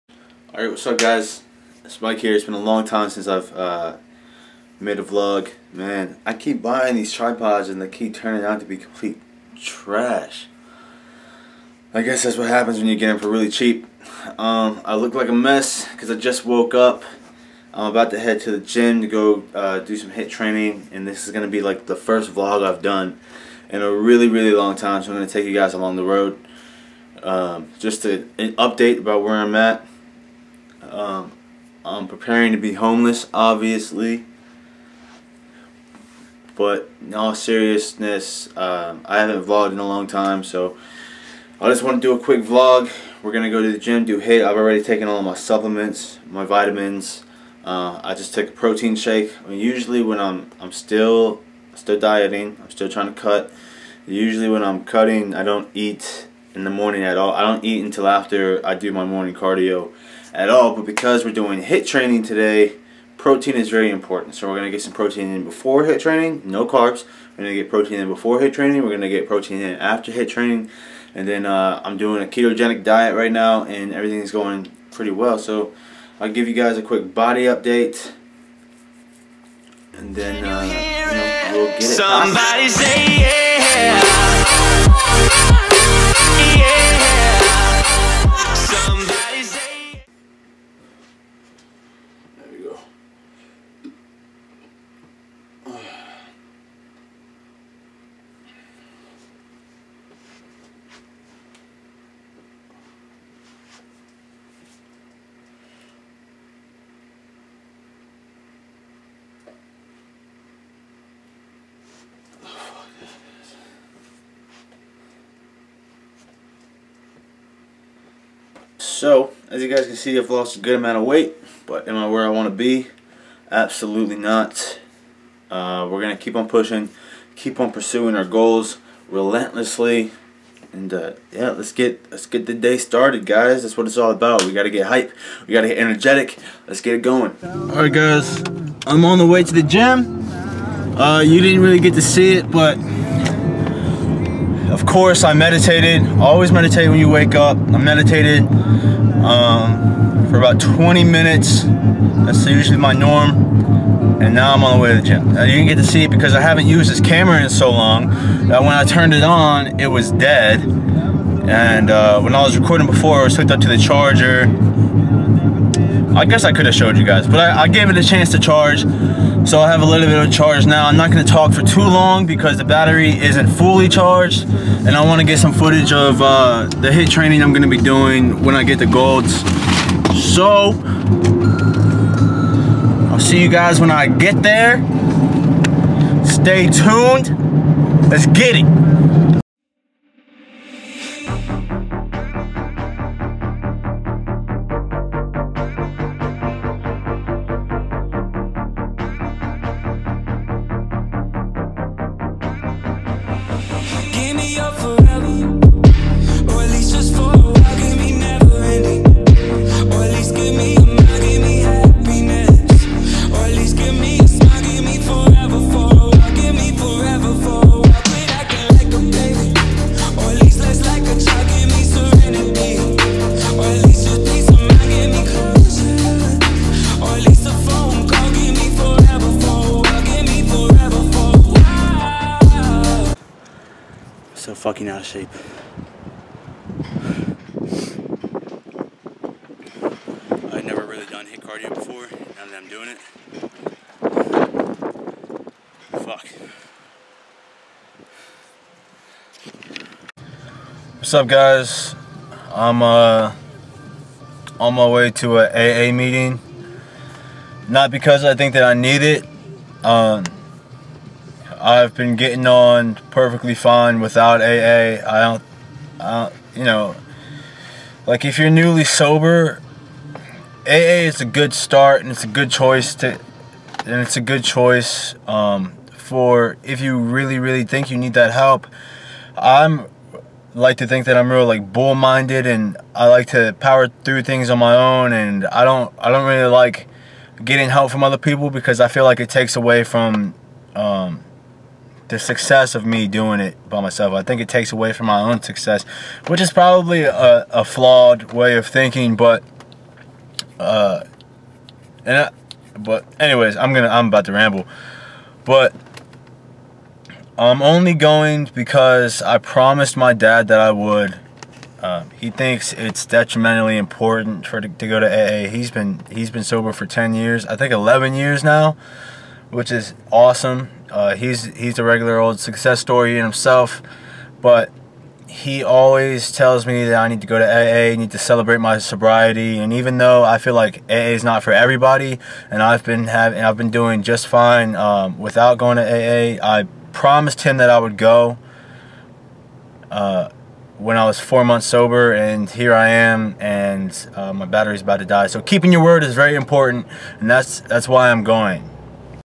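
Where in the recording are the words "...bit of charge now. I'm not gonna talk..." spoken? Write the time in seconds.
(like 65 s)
170 s.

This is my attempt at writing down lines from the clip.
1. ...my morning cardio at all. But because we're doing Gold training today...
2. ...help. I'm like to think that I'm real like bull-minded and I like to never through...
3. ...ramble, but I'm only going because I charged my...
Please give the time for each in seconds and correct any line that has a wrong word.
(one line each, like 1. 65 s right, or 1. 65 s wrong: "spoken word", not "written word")
1. 58 s wrong: "HIIT", not "Gold"
2. 278 s wrong: "power", not "never"
3. 304 s wrong: "promised", not "charged".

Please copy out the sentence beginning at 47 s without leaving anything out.
Uh, I just took a protein shake.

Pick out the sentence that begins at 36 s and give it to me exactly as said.
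But in all seriousness, uh, I haven't vlogged in a long time, so I just want to do a quick vlog.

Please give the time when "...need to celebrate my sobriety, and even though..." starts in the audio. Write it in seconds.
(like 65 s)
327 s.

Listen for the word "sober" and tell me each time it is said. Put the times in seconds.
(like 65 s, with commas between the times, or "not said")
268 s, 316 s, 341 s.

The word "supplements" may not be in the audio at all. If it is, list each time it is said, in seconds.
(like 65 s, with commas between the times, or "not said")
45 s.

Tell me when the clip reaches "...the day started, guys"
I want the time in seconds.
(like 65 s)
132 s.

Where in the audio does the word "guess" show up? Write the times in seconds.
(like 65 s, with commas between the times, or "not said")
12 s, 166 s.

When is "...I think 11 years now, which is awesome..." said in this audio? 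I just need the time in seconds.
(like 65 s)
317 s.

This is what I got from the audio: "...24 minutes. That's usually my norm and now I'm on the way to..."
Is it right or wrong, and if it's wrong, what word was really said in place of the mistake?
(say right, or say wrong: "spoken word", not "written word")
wrong: "20", not "24".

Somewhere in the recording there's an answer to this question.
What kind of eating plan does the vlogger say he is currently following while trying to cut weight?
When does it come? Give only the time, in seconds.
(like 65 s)
72 s.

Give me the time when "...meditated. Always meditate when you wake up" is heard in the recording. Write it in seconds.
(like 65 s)
145 s.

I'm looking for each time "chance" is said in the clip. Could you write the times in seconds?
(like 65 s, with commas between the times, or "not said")
168 s.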